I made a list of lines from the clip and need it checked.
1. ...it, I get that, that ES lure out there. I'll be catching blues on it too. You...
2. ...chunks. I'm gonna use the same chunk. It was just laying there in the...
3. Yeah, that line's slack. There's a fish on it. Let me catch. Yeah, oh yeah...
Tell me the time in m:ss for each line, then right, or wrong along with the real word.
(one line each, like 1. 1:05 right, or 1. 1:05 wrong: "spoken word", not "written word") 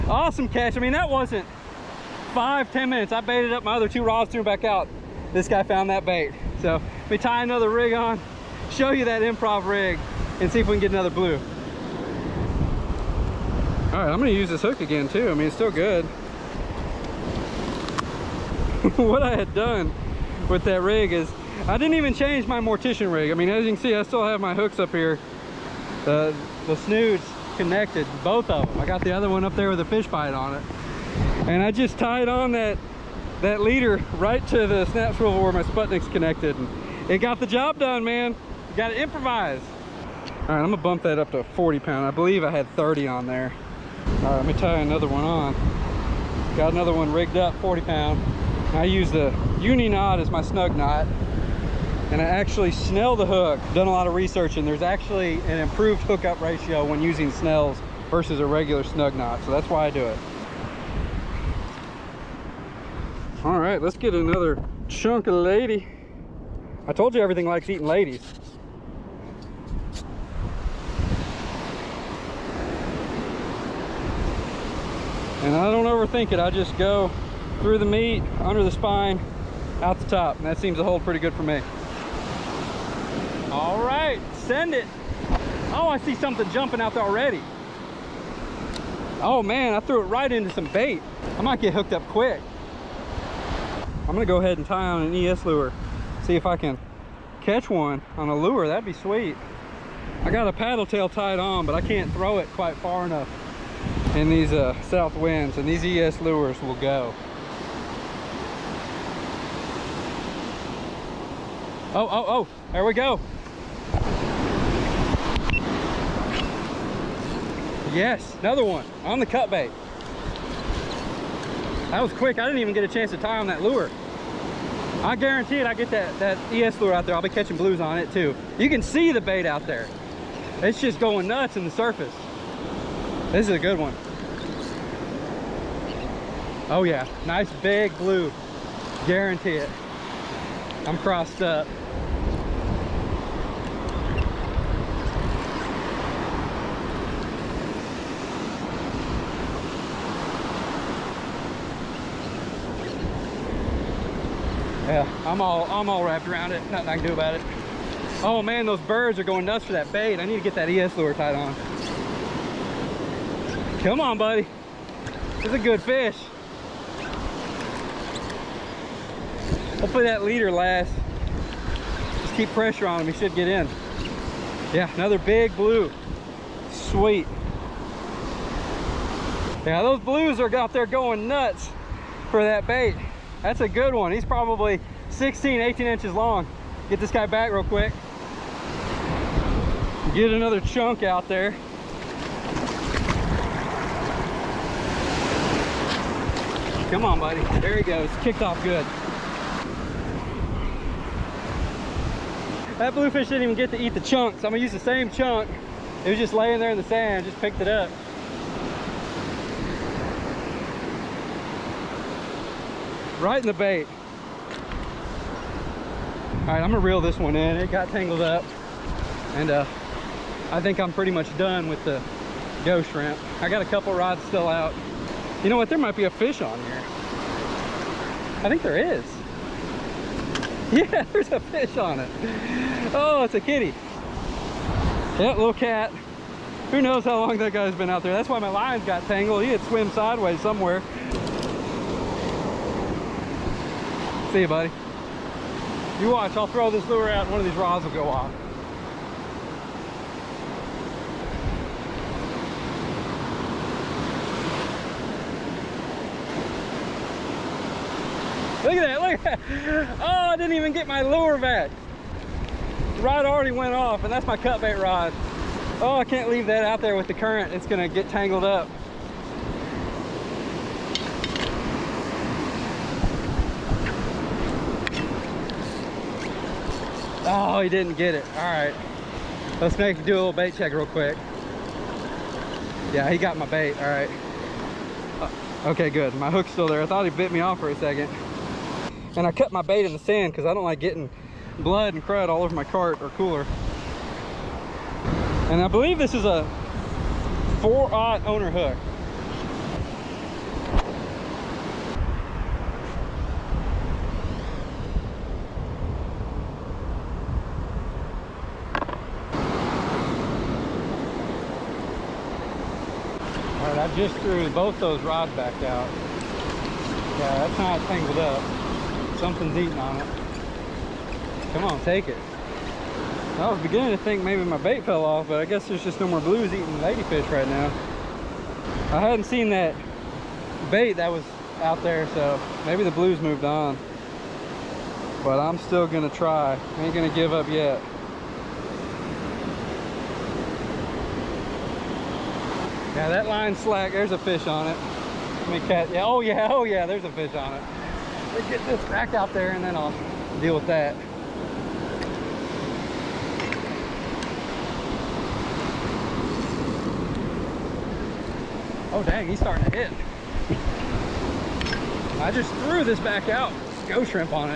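1. 2:05 right
2. 3:23 right
3. 5:42 right.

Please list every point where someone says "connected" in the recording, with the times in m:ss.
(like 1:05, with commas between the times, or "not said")
0:27, 0:36.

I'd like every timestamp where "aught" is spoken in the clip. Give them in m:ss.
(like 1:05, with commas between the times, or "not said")
4:57.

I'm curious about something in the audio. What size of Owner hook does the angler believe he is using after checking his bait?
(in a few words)
4/0.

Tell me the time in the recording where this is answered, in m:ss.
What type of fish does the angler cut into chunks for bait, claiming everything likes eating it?
1:05.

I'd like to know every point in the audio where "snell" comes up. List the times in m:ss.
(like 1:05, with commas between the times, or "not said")
0:52, 0:57.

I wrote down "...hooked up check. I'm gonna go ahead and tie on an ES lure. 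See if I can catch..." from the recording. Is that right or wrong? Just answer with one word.
wrong.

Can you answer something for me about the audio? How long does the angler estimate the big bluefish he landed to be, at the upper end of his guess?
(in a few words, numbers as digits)
18 inches.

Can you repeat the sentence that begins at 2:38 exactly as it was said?
Oh man, those birds are going nuts for that bait.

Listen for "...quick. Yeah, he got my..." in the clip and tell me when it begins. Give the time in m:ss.
4:40.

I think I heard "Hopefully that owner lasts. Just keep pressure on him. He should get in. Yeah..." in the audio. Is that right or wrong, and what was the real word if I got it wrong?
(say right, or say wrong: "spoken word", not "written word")
wrong: "leader", not "owner".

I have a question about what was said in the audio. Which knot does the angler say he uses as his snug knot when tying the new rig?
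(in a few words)
uni knot.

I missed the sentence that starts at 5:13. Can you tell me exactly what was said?
All right, I just threw both those rods back out.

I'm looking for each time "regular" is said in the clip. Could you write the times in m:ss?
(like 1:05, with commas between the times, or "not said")
0:58.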